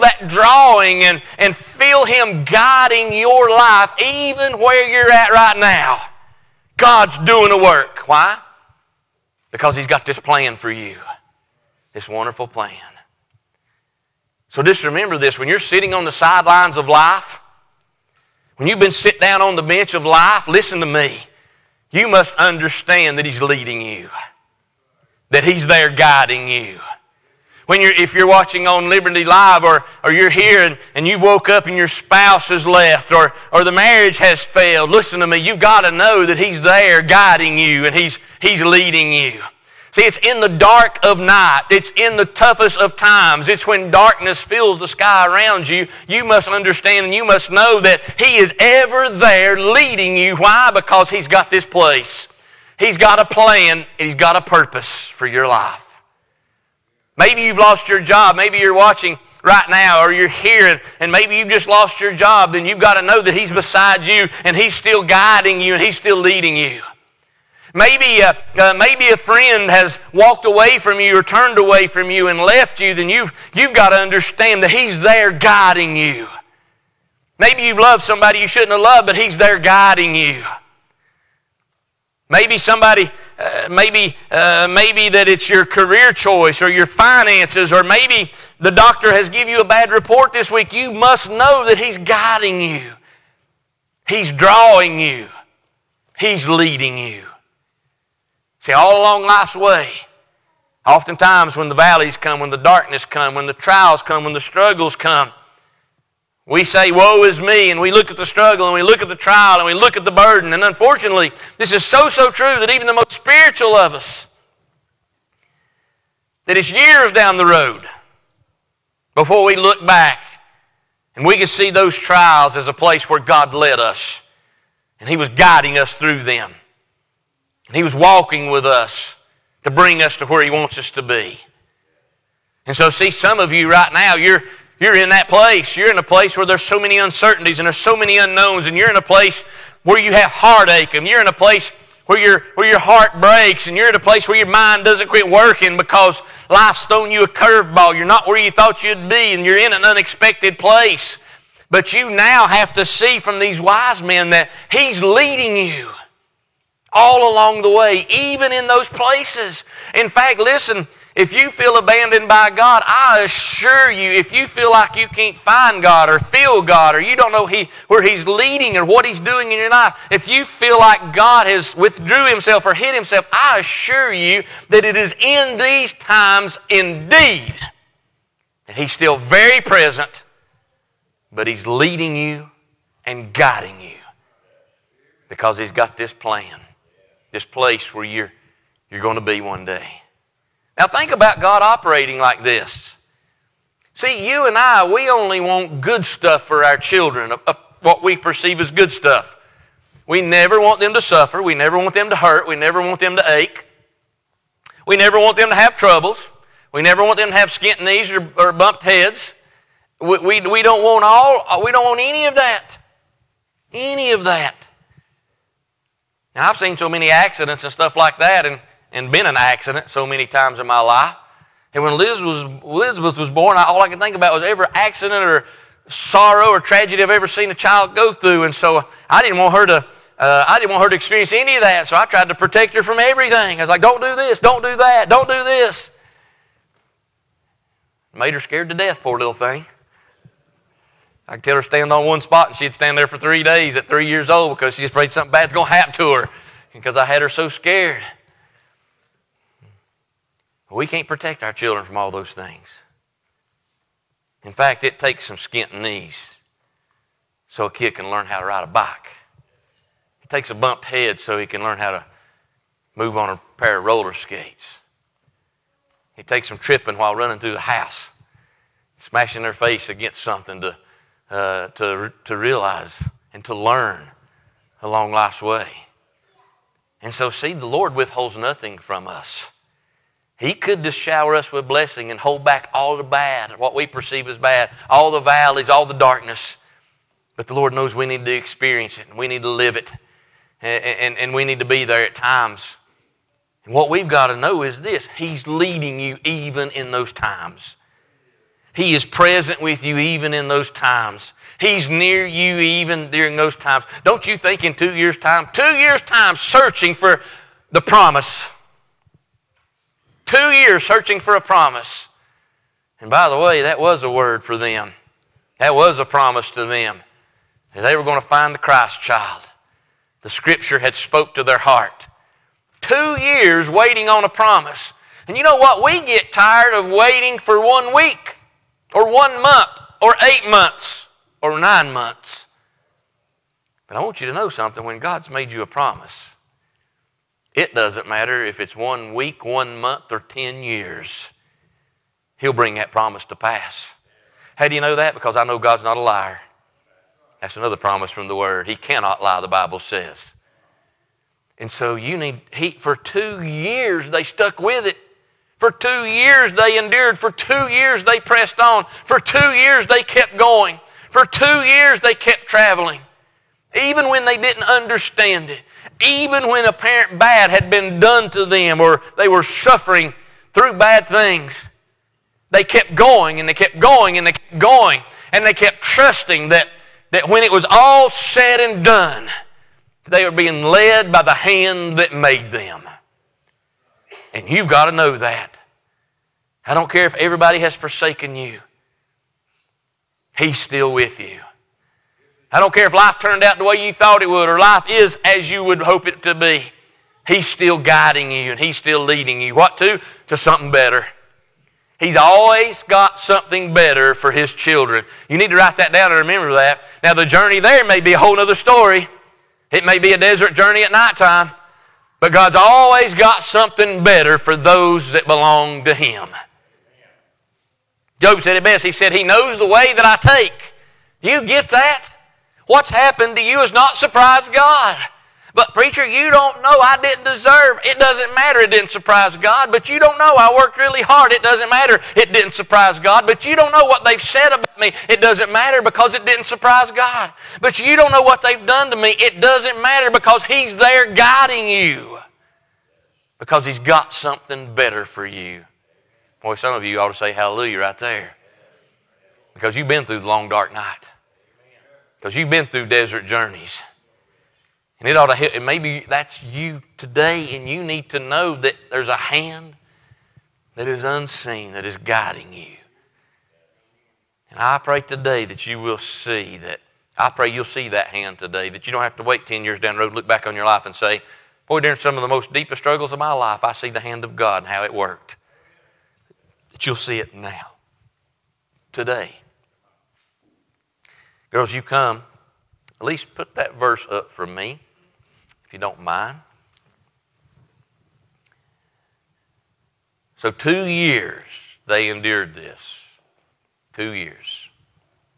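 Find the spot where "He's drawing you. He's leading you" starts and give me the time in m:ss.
1:34.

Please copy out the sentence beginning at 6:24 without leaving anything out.
And you've got to know that.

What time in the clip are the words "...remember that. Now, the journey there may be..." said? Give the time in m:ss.
6:46.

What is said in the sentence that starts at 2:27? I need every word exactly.
You're not where you thought you'd be and you're in an unexpected place.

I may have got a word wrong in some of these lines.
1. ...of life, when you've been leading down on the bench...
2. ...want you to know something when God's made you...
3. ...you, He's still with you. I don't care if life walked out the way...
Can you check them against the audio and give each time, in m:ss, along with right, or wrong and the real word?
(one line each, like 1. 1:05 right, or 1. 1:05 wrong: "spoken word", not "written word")
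1. 0:16 wrong: "sitting", not "leading"
2. 5:34 right
3. 6:28 wrong: "turned", not "walked".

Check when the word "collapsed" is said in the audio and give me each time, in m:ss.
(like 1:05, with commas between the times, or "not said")
not said.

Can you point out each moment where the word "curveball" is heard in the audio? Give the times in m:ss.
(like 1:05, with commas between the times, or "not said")
2:27.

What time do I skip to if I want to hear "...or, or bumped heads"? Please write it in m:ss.
3:28.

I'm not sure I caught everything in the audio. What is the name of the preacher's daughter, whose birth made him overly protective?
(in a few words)
Elizabeth.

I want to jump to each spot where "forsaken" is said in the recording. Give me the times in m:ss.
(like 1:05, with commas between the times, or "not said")
6:27.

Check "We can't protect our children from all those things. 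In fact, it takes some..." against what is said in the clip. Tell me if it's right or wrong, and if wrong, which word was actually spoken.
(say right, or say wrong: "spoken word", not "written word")
right.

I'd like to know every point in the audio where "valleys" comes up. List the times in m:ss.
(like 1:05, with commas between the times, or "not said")
1:41, 4:45.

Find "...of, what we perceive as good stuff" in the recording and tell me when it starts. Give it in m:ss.
3:17.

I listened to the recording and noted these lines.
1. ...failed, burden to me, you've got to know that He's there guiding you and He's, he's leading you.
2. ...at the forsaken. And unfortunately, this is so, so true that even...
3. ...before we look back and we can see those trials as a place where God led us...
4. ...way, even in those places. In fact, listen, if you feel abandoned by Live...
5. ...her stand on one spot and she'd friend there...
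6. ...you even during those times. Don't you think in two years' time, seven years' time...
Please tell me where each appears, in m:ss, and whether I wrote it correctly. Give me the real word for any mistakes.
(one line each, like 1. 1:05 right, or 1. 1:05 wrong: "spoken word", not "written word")
1. 0:34 wrong: "listen", not "burden"
2. 1:49 wrong: "burden", not "forsaken"
3. 1:59 right
4. 2:37 wrong: "God", not "Live"
5. 4:01 wrong: "stand", not "friend"
6. 5:02 wrong: "two", not "seven".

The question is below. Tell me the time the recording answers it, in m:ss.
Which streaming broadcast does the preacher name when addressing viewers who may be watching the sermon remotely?
0:28.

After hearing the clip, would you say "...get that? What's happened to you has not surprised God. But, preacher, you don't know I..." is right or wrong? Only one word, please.
right.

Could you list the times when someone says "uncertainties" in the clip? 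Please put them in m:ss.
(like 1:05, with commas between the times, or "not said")
2:16.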